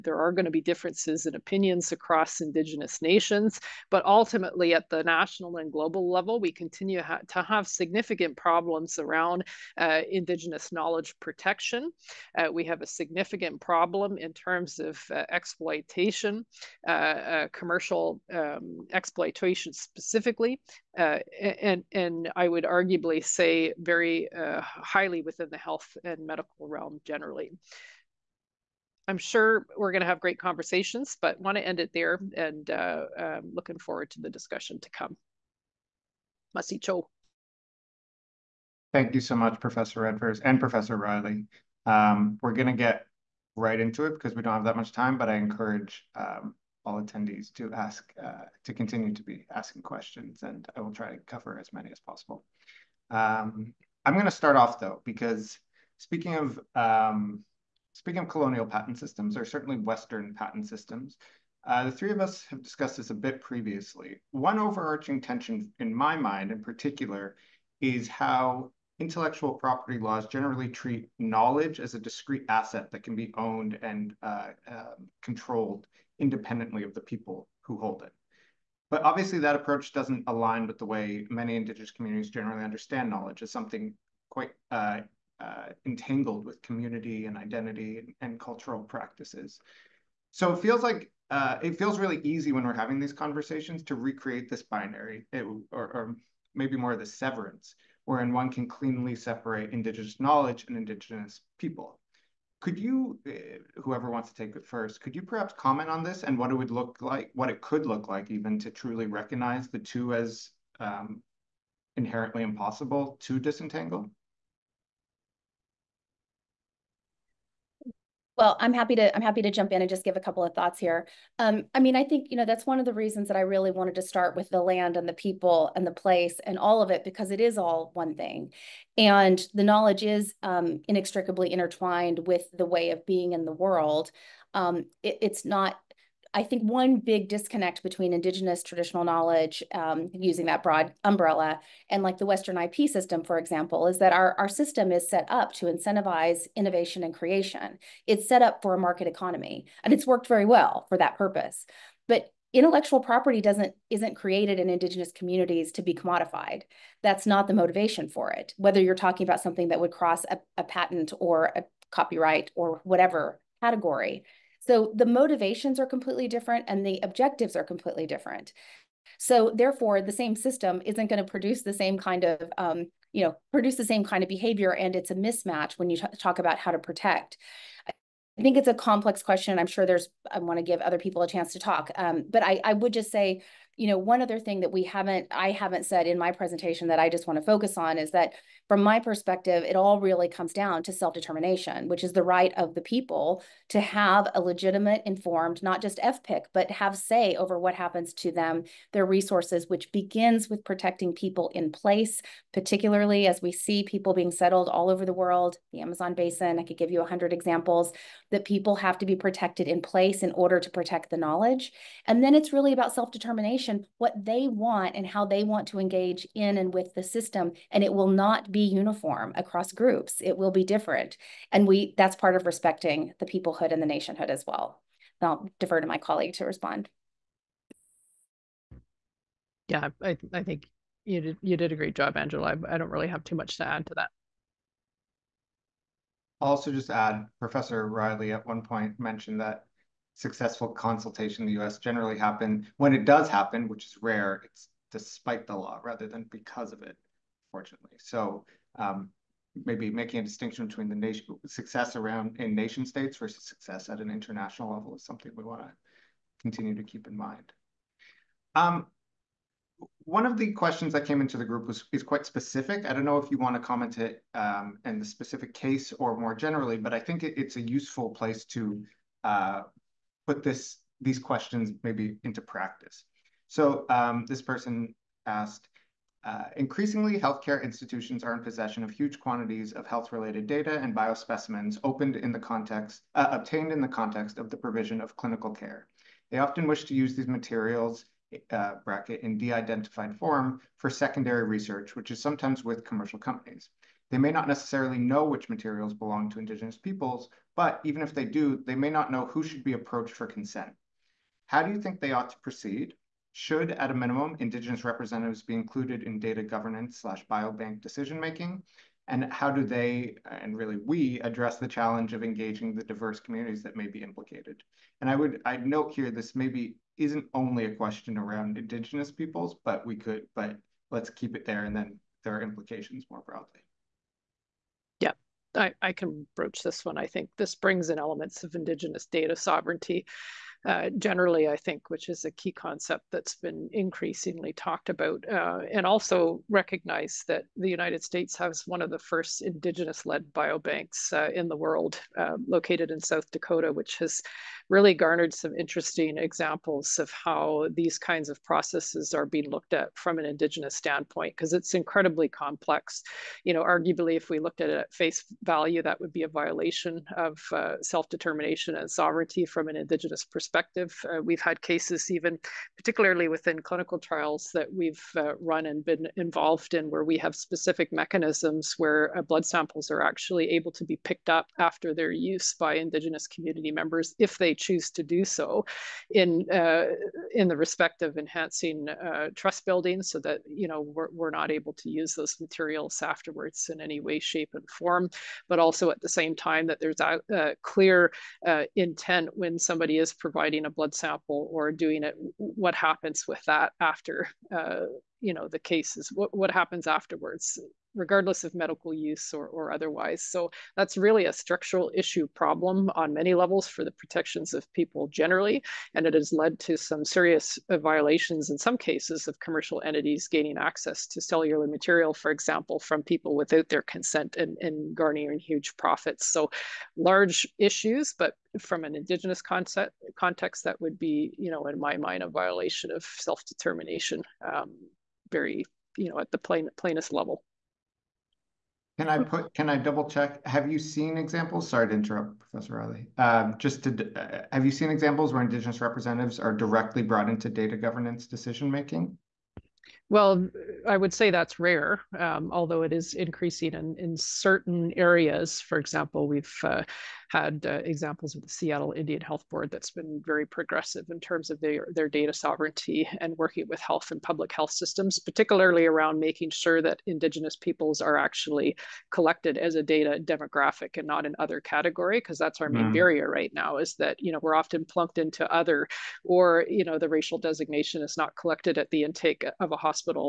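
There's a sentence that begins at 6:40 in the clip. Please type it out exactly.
So that's really a structural issue problem on many levels for the protections of people generally.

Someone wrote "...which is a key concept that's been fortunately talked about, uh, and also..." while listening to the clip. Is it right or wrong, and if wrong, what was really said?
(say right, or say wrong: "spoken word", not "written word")
wrong: "increasingly", not "fortunately".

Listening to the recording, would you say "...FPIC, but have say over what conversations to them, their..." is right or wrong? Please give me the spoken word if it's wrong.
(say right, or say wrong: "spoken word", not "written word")
wrong: "happens", not "conversations".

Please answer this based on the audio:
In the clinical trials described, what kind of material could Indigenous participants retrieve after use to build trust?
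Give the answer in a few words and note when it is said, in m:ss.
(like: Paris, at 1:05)
blood samples, at 6:09.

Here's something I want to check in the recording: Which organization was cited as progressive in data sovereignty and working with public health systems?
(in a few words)
Seattle Indian Health Board.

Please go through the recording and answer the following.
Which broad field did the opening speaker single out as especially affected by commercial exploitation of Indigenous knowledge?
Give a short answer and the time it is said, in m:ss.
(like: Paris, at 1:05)
health and medical realm, at 0:25.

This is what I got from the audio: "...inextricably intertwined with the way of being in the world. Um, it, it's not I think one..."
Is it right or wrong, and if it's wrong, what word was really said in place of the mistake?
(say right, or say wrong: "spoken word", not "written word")
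right.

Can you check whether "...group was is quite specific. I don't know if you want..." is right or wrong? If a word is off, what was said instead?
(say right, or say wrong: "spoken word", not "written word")
right.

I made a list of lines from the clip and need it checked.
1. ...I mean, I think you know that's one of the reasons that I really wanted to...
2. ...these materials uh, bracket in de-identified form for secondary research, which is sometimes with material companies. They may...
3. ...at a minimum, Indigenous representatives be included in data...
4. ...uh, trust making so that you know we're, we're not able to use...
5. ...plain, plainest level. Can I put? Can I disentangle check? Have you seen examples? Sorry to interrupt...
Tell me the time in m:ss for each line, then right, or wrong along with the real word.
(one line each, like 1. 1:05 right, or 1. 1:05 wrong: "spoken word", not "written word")
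1. 2:01 right
2. 4:47 wrong: "commercial", not "material"
3. 5:03 right
4. 6:18 wrong: "building", not "making"
5. 7:06 wrong: "double", not "disentangle".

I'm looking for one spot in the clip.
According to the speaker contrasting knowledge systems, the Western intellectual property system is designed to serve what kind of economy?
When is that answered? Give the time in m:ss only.
2:28.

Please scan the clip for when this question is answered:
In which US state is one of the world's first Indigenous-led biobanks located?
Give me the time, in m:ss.
5:42.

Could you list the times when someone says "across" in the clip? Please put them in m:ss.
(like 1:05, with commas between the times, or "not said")
0:01, 3:39.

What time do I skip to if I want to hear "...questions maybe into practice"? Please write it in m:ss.
4:31.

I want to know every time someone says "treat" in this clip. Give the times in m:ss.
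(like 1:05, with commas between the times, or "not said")
1:10.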